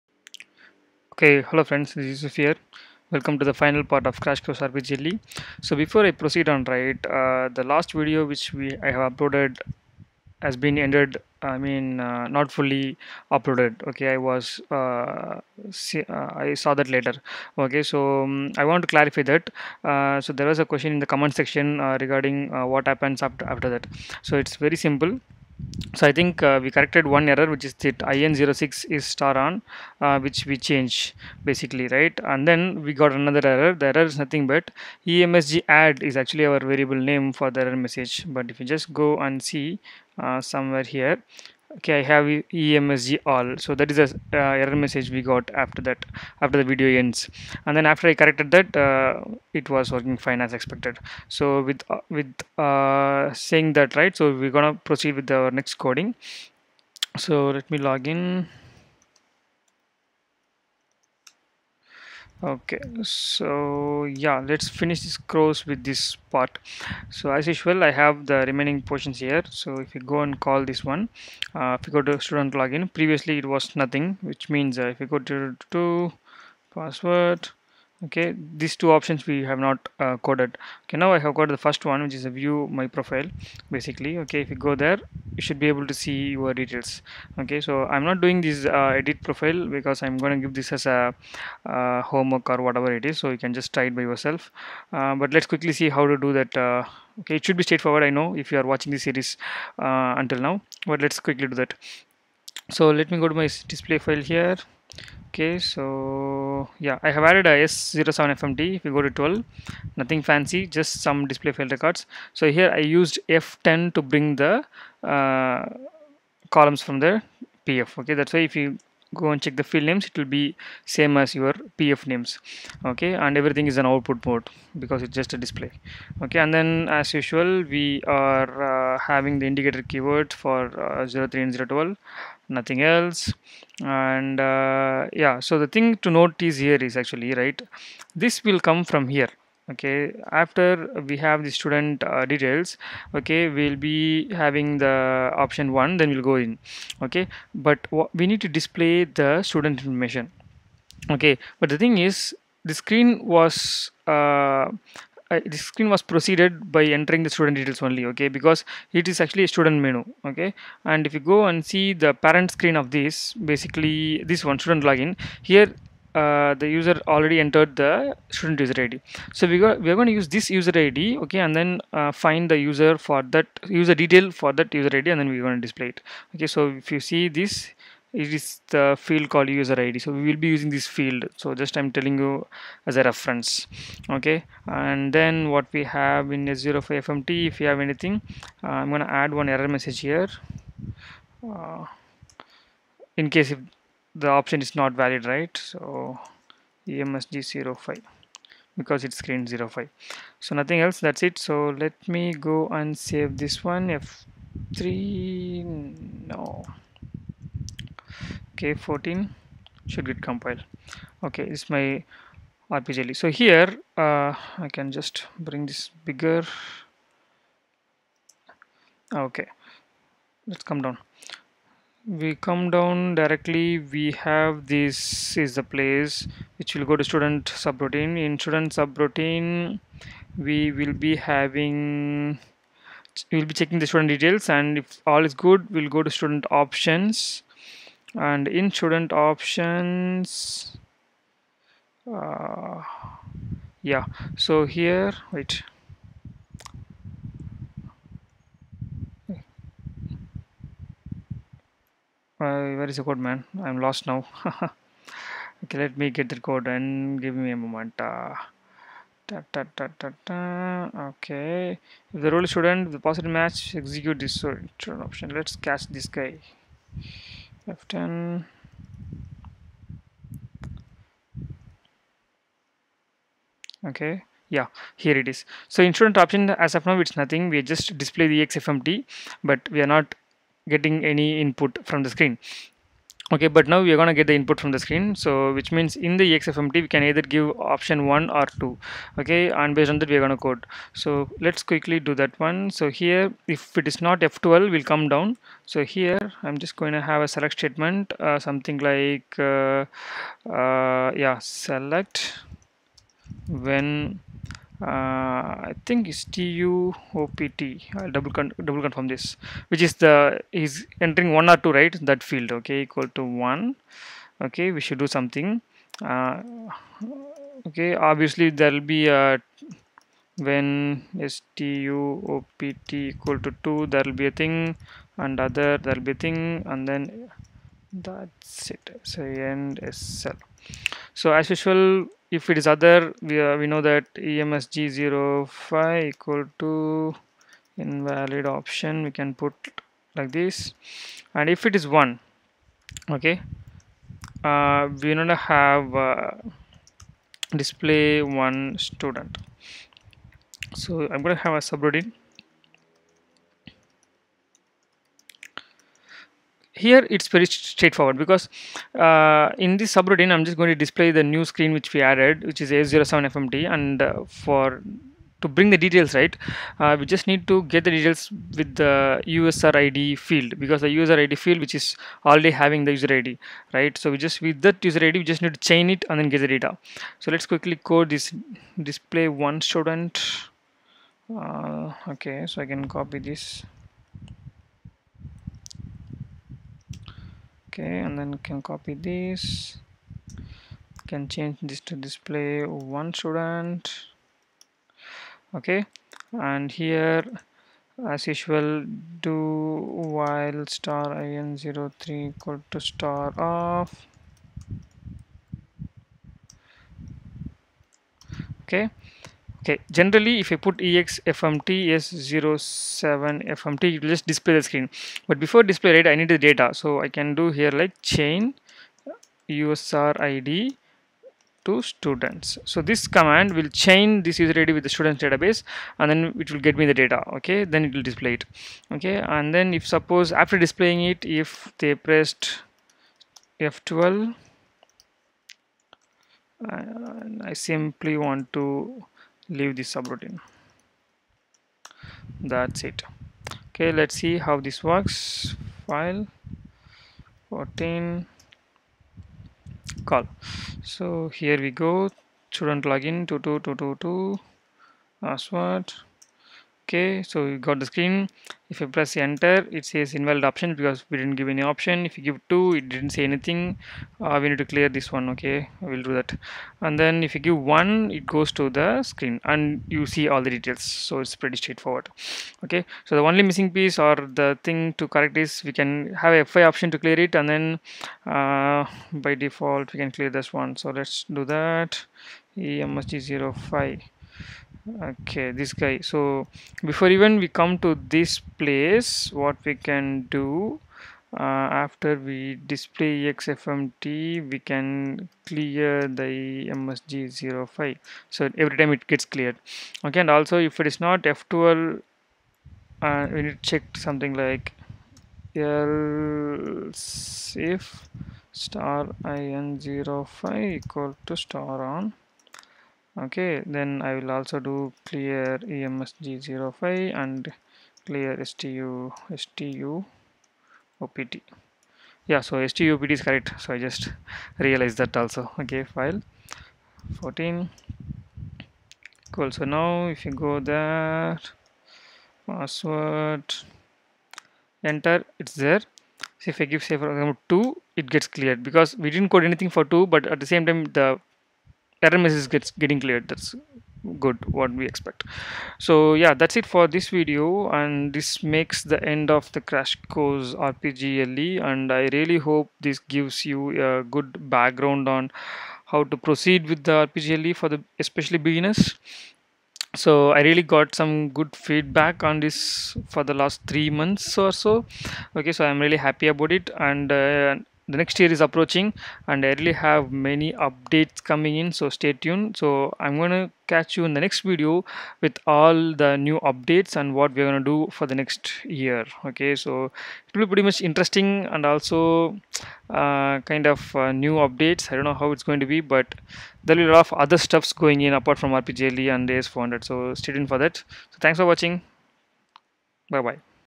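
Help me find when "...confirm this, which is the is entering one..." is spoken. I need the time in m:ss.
5:08.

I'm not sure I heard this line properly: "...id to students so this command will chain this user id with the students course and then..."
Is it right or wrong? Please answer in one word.
wrong.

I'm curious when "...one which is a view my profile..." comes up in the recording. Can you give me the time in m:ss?
1:21.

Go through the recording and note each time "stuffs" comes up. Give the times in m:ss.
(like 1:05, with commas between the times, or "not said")
9:47.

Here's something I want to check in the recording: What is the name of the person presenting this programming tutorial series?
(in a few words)
Yusuf.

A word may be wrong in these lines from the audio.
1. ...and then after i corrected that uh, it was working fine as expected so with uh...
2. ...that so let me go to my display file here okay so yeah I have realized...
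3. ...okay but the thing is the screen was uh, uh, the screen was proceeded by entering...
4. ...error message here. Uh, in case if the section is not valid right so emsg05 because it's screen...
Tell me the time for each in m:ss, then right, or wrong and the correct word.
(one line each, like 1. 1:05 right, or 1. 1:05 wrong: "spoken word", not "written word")
1. 0:47 right
2. 1:41 wrong: "added", not "realized"
3. 2:31 right
4. 3:09 wrong: "option", not "section".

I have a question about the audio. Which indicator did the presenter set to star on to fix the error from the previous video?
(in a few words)
IN06.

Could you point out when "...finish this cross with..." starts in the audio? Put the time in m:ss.
1:04.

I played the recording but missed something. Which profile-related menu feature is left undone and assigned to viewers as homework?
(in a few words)
edit profile.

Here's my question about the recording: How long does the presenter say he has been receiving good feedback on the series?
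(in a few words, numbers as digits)
three months.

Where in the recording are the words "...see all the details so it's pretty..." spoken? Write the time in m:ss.
7:50.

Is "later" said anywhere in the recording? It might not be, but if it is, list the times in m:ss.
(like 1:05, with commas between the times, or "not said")
0:16.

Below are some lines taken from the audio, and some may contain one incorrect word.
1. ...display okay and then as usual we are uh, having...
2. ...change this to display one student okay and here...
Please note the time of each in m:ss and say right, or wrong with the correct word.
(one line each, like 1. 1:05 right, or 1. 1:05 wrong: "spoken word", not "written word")
1. 2:05 right
2. 6:31 right.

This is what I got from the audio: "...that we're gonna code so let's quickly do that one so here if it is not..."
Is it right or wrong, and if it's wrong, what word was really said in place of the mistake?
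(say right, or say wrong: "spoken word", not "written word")
right.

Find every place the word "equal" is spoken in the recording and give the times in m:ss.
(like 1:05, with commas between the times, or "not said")
5:12, 5:22, 5:36, 6:42, 8:30.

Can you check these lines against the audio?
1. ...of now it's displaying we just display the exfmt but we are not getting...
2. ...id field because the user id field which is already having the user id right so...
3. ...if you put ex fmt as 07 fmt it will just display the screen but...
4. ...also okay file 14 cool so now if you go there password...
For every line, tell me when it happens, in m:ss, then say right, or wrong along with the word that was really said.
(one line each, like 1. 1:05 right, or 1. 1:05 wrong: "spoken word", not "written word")
1. 4:36 wrong: "nothing", not "displaying"
2. 6:09 right
3. 6:50 right
4. 8:45 right.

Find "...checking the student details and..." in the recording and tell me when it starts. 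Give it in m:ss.
3:53.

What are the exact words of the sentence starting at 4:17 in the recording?
Uh, da, da, da, okay, if the role student, the positive match, execute this return option.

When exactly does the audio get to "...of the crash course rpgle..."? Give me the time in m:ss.
9:09.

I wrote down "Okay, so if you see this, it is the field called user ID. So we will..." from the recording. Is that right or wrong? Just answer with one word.
right.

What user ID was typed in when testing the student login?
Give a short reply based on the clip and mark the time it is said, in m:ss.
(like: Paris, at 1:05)
22222, at 7:33.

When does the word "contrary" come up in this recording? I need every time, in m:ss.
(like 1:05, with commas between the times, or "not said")
not said.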